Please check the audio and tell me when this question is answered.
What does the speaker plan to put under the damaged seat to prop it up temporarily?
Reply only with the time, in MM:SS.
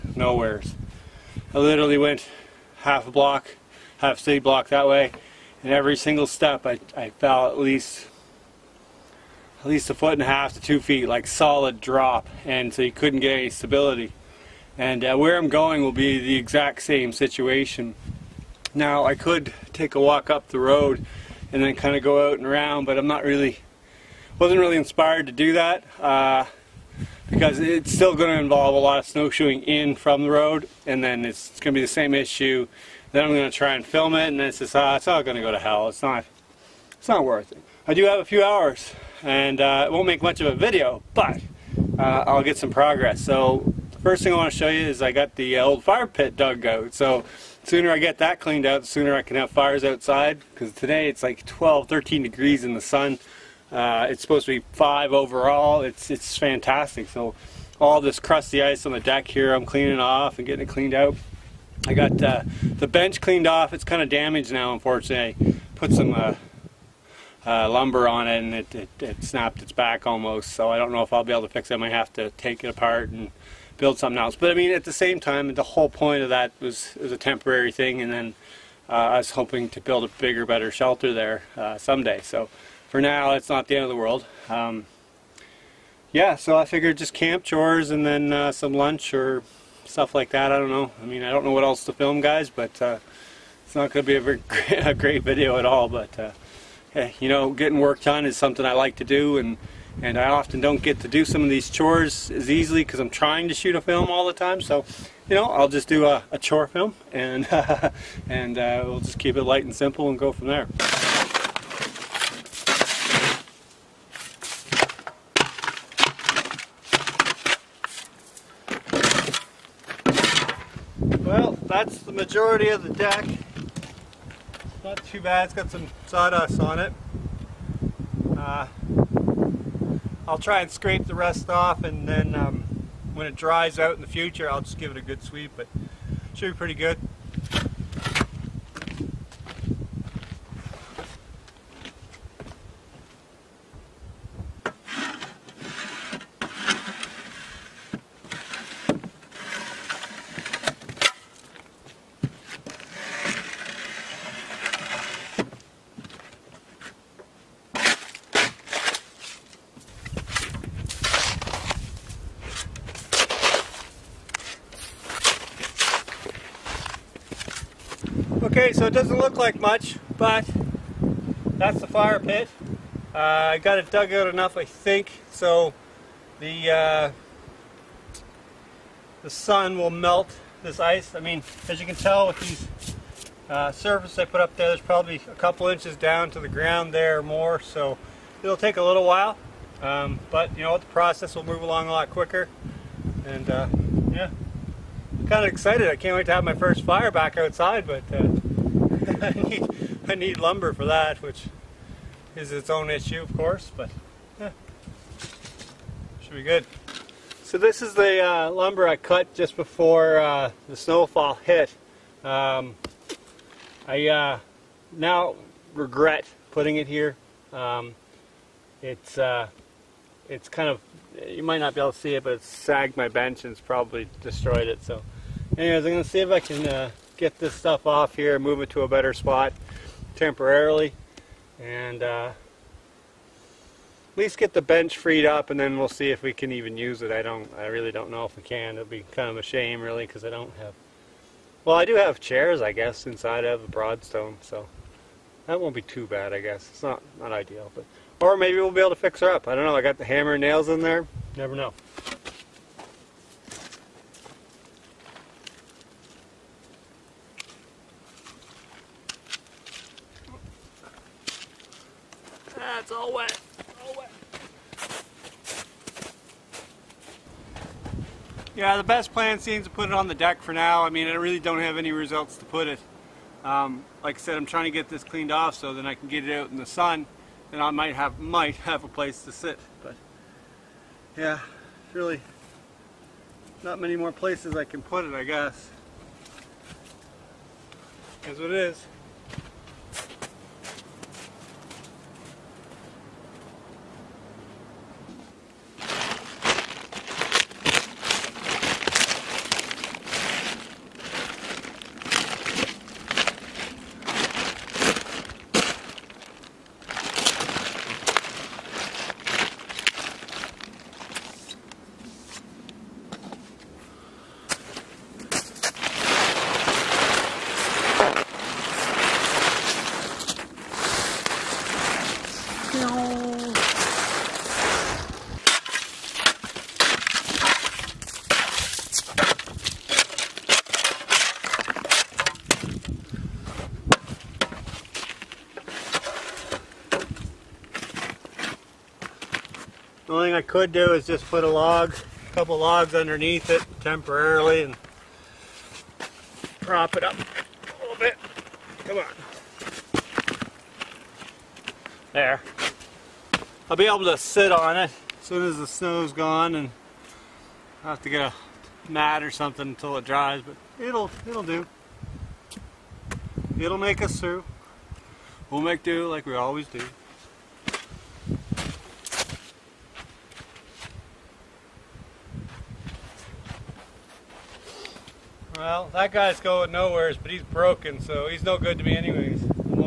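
05:41.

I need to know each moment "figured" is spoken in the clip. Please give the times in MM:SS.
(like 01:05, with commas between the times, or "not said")
01:26.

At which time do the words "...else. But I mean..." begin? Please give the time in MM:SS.
01:14.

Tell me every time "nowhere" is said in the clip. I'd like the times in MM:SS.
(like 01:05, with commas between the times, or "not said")
00:00, 06:16.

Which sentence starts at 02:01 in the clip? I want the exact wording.
That's the majority of the deck.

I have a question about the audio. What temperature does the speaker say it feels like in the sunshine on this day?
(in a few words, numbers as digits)
12 to 13 degrees.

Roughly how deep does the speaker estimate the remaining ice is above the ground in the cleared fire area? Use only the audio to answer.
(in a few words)
A couple inches.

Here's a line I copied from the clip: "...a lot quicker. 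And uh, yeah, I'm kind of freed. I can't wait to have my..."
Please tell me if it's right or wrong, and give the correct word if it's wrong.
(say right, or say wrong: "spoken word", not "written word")
wrong: "excited", not "freed".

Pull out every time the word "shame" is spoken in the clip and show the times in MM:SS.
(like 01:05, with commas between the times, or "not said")
03:59.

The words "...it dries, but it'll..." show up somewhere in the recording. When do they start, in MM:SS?
05:59.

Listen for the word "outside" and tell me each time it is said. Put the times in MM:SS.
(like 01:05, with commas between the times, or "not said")
00:49, 03:17.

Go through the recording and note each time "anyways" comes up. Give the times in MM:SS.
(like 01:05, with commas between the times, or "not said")
03:45, 06:18.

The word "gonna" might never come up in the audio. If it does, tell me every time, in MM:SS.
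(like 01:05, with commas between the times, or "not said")
03:45.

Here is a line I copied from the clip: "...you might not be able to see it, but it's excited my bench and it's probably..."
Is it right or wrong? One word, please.
wrong.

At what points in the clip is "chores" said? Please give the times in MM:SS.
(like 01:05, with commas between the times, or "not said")
01:27, 01:41, 01:46.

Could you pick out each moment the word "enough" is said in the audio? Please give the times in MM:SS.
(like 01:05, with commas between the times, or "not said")
02:54.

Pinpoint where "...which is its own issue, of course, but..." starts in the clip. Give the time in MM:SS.
03:21.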